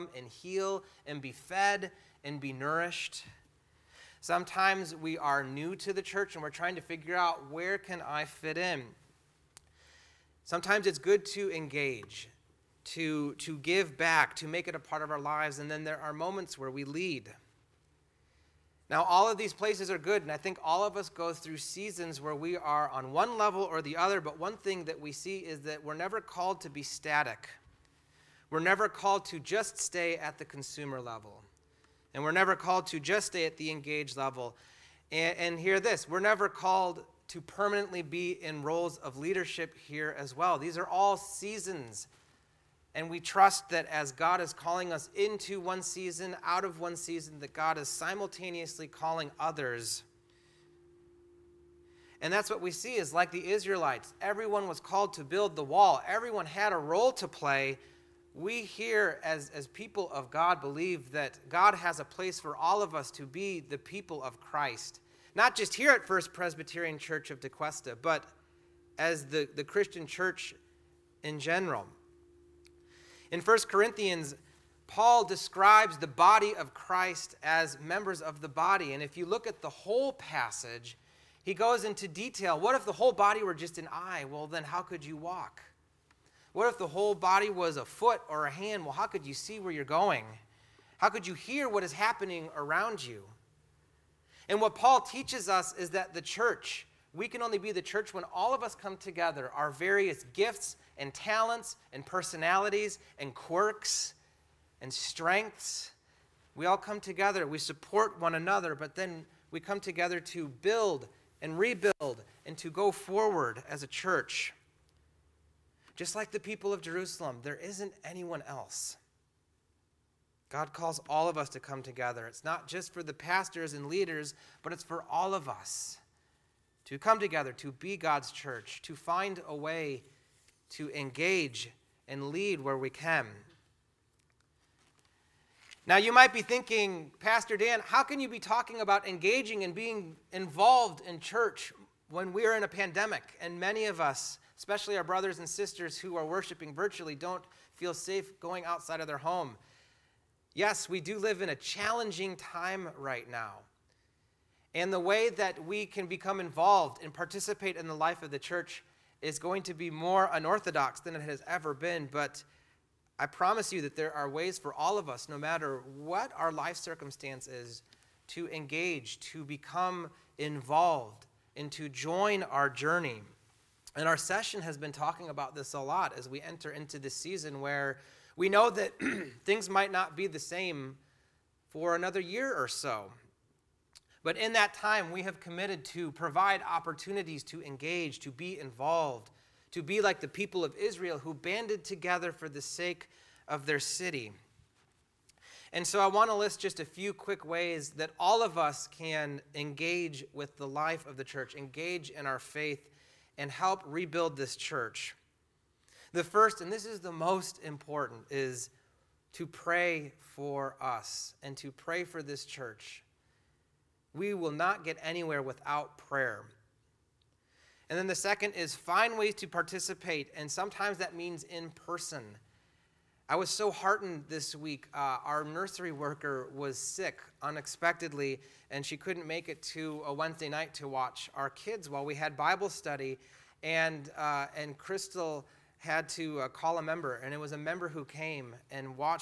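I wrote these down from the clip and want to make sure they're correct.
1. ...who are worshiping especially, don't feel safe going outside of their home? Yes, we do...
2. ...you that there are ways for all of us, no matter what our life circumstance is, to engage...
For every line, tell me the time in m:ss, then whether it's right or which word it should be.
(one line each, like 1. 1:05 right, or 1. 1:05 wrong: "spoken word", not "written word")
1. 2:25 wrong: "virtually", not "especially"
2. 2:43 right.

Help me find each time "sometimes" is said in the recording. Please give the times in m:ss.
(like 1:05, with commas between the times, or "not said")
0:04, 0:10, 3:40.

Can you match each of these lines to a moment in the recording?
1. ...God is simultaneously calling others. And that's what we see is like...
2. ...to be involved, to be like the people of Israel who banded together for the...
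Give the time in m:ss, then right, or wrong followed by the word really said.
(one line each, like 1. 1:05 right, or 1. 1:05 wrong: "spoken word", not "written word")
1. 0:47 right
2. 3:08 right.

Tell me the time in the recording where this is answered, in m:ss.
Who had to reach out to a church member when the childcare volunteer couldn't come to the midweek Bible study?
3:54.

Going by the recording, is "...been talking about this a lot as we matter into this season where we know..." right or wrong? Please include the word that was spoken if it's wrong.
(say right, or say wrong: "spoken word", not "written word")
wrong: "enter", not "matter".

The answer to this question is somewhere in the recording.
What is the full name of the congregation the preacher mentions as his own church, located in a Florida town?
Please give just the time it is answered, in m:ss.
1:06.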